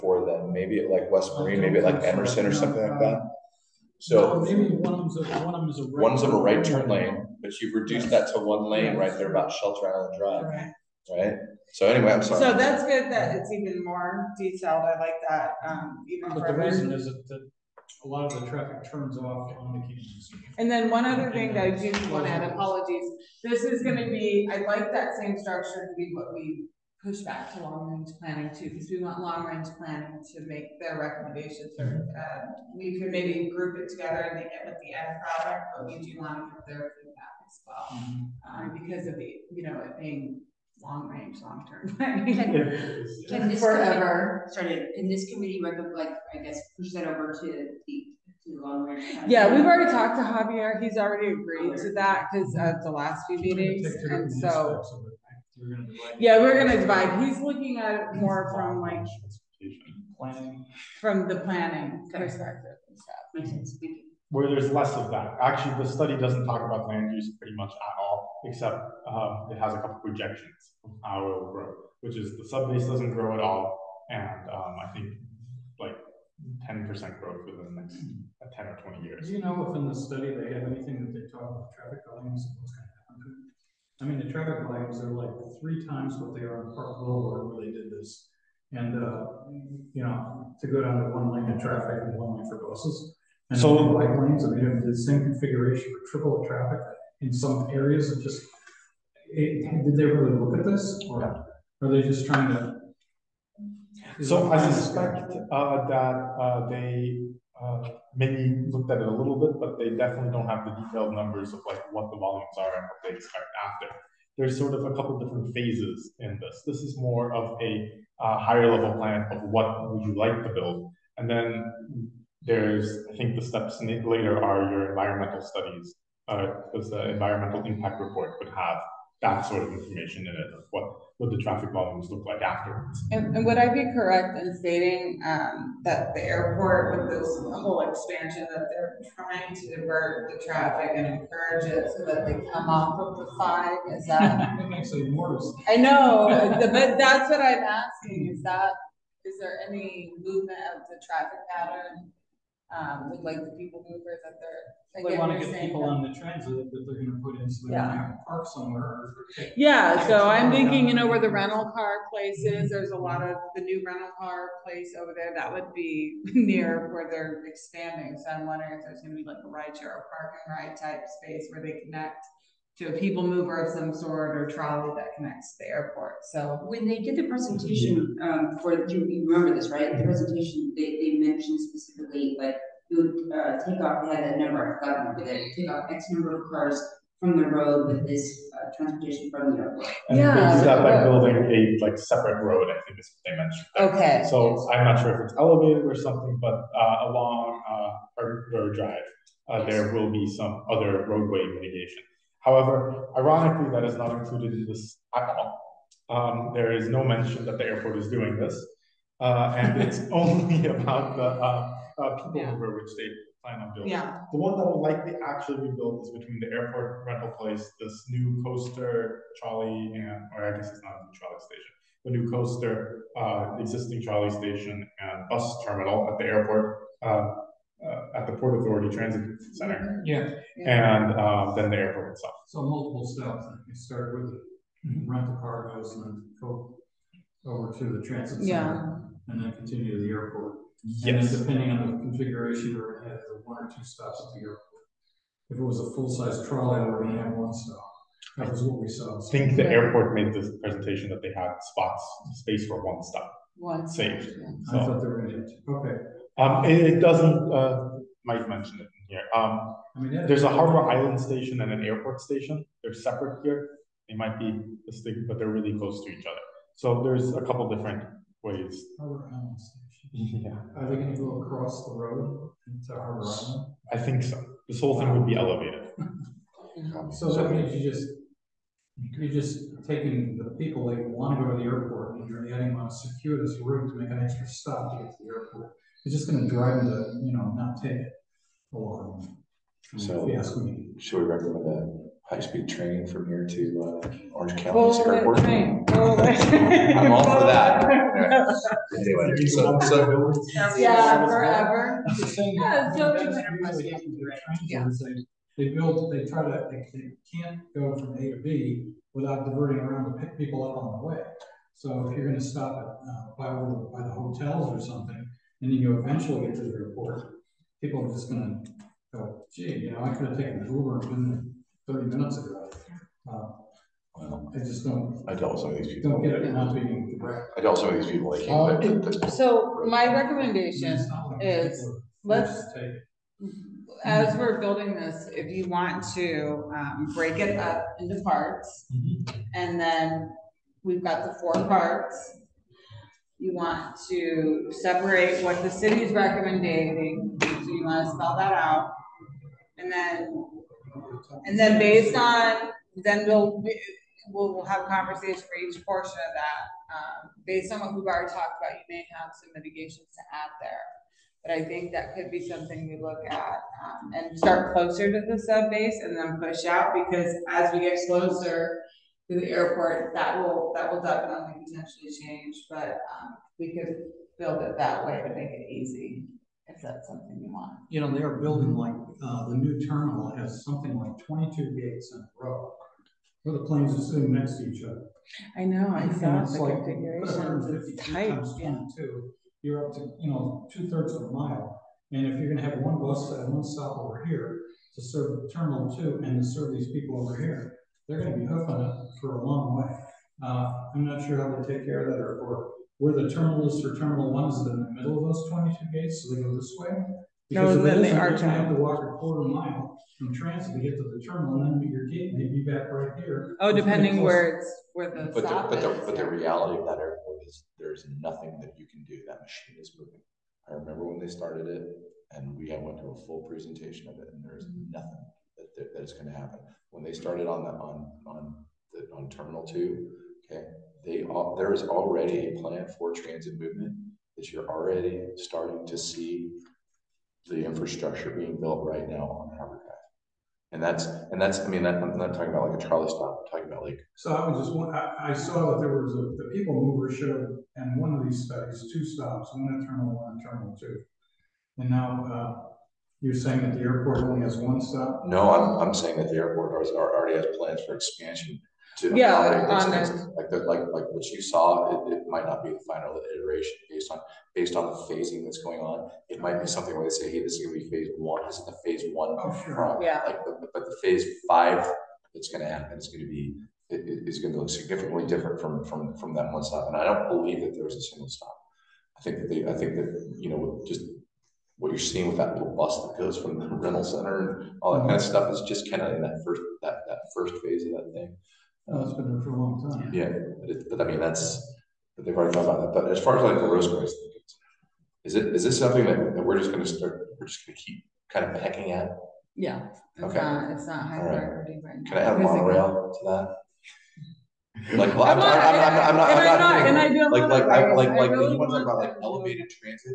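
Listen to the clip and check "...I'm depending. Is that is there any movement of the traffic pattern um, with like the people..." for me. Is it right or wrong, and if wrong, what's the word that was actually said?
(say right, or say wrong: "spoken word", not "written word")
wrong: "asking", not "depending".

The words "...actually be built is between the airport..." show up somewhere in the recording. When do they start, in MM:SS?
03:35.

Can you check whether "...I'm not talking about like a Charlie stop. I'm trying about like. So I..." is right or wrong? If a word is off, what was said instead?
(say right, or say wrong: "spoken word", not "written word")
wrong: "talking", not "trying".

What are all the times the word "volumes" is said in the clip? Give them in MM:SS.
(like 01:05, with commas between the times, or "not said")
01:22, 01:52, 02:11.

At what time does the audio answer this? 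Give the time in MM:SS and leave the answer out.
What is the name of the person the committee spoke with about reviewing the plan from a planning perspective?
00:50.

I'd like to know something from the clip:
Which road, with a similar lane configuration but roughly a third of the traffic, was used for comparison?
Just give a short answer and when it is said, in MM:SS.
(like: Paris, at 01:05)
Park Boulevard, at 01:26.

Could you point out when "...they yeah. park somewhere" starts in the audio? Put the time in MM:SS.
02:37.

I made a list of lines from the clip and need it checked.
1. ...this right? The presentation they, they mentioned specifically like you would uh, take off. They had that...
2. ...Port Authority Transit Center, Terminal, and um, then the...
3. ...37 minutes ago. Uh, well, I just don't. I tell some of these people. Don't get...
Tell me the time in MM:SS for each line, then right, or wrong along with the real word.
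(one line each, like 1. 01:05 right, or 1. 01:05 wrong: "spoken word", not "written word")
1. 02:59 right
2. 03:48 wrong: "Yeah", not "Terminal"
3. 05:21 wrong: "30", not "37".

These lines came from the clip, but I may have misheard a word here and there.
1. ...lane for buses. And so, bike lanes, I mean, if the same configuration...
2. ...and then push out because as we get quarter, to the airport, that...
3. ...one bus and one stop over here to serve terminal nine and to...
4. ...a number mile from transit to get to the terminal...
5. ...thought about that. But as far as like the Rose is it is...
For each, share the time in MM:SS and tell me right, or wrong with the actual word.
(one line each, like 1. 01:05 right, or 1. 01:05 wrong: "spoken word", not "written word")
1. 01:32 right
2. 06:06 wrong: "closer", not "quarter"
3. 06:32 wrong: "two", not "nine"
4. 06:49 wrong: "quarter", not "number"
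5. 08:12 right.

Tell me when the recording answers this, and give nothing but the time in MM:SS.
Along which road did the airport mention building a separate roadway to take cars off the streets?
03:18.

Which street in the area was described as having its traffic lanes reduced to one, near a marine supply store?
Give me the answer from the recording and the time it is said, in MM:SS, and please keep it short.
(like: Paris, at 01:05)
Shelter Island Drive, at 00:09.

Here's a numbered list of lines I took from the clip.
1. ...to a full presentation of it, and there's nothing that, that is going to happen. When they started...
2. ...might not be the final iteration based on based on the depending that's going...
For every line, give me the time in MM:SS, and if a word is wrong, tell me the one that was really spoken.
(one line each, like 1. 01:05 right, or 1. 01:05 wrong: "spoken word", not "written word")
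1. 07:02 right
2. 07:42 wrong: "phasing", not "depending".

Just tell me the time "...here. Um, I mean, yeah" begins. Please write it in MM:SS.
04:19.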